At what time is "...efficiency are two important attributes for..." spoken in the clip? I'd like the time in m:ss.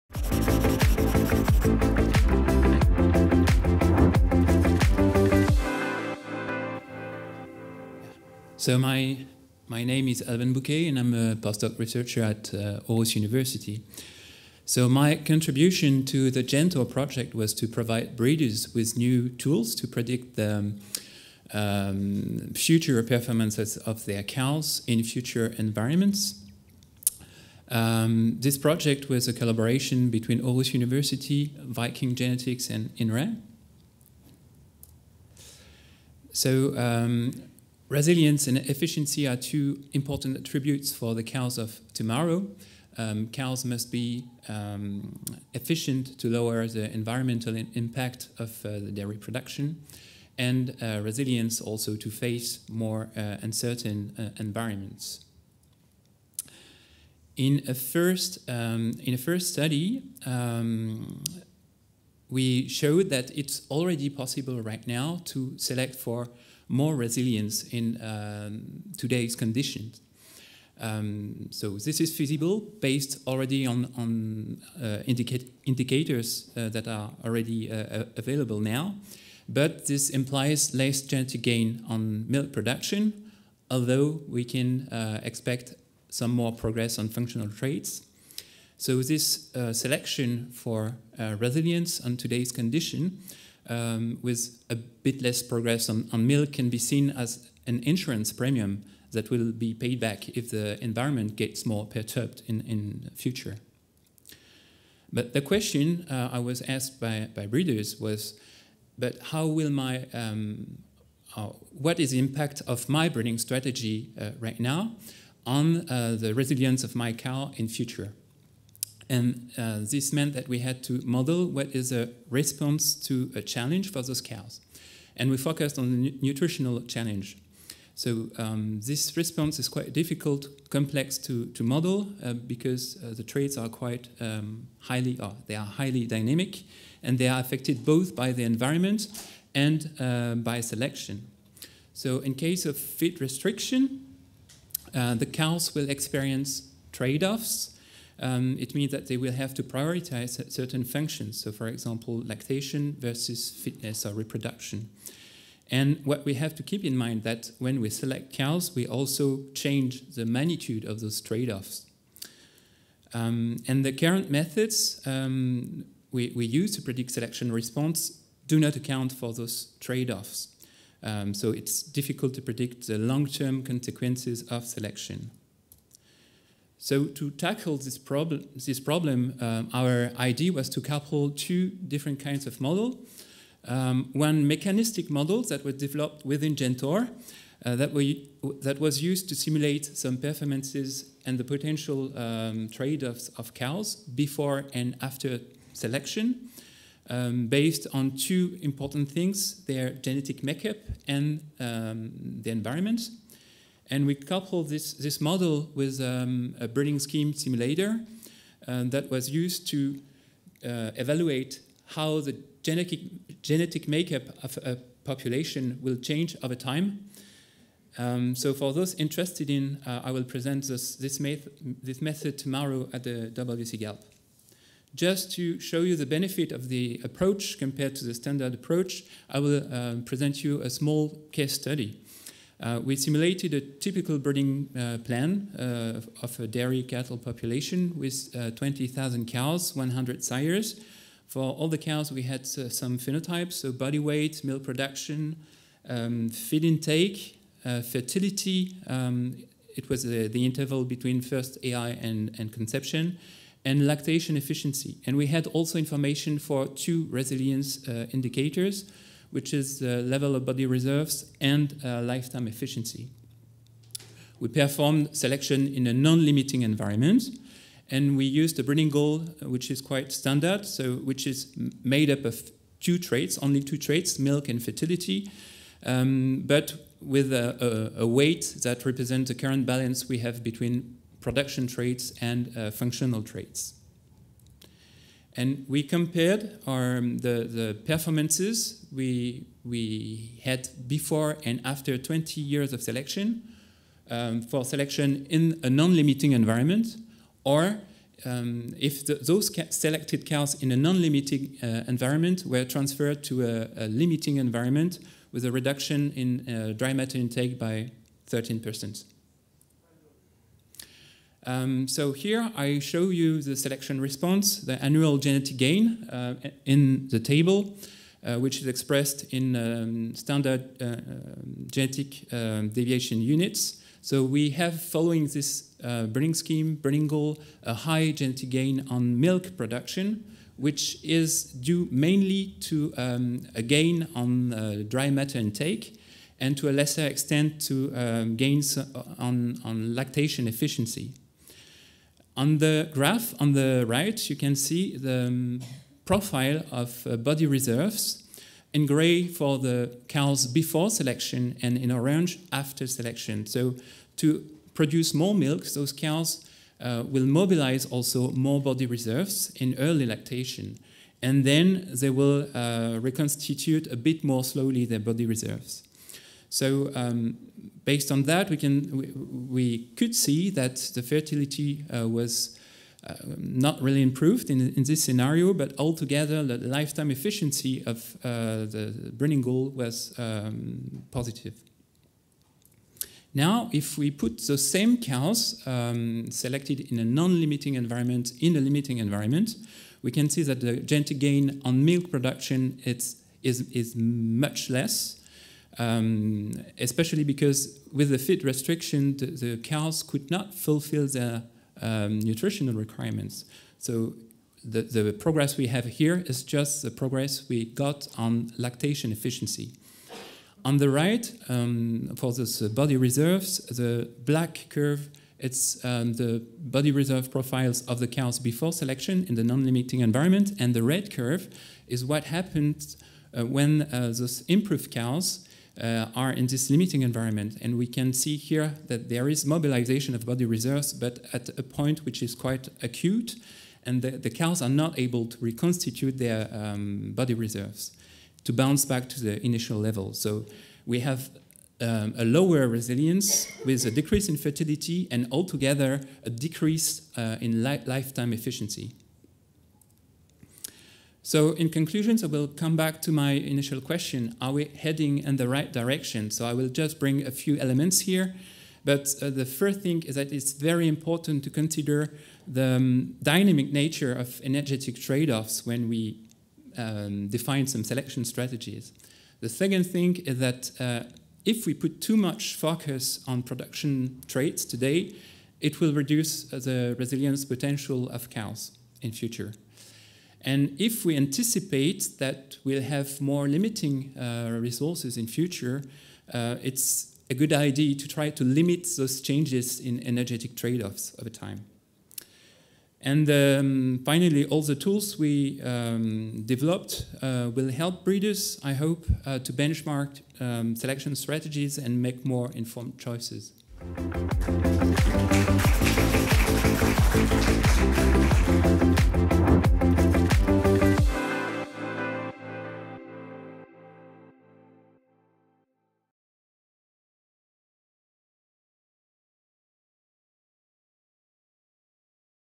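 0:38.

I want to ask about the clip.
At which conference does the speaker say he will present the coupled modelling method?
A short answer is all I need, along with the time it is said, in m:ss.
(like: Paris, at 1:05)
WCGALP, at 3:43.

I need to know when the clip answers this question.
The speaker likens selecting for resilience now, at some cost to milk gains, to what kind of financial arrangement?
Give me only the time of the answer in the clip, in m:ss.
1:37.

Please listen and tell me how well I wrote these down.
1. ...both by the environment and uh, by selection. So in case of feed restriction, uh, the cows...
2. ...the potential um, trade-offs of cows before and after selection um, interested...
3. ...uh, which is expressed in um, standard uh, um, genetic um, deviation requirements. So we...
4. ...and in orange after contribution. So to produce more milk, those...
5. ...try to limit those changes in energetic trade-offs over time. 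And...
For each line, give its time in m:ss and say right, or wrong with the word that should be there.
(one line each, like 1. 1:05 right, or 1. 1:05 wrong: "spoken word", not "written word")
1. 2:17 right
2. 3:11 wrong: "based", not "interested"
3. 5:18 wrong: "units", not "requirements"
4. 5:51 wrong: "selection", not "contribution"
5. 8:08 right.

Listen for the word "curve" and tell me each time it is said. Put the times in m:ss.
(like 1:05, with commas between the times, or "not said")
6:54, 7:01.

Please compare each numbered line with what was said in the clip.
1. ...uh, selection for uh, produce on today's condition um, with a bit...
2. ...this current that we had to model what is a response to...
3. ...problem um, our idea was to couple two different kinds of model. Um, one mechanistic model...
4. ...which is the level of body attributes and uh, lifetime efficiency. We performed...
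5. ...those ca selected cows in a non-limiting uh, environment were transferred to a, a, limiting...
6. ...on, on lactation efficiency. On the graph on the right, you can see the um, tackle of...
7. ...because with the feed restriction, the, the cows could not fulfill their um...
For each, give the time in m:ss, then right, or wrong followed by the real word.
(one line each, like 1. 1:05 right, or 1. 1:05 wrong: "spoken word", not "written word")
1. 1:29 wrong: "resilience", not "produce"
2. 1:59 wrong: "meant", not "current"
3. 2:58 right
4. 4:19 wrong: "reserves", not "attributes"
5. 4:59 right
6. 5:39 wrong: "profile", not "tackle"
7. 6:37 right.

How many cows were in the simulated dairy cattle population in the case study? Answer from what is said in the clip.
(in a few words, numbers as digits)
20,000.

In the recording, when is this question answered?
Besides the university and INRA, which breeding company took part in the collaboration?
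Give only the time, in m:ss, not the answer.
0:31.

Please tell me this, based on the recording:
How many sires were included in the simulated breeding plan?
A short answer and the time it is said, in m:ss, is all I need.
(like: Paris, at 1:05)
100, at 3:59.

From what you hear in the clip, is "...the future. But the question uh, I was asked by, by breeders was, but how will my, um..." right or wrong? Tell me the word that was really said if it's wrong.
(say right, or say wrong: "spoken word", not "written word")
right.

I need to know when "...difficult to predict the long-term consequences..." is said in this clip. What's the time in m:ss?
2:51.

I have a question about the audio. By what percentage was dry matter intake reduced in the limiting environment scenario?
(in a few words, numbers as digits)
13%.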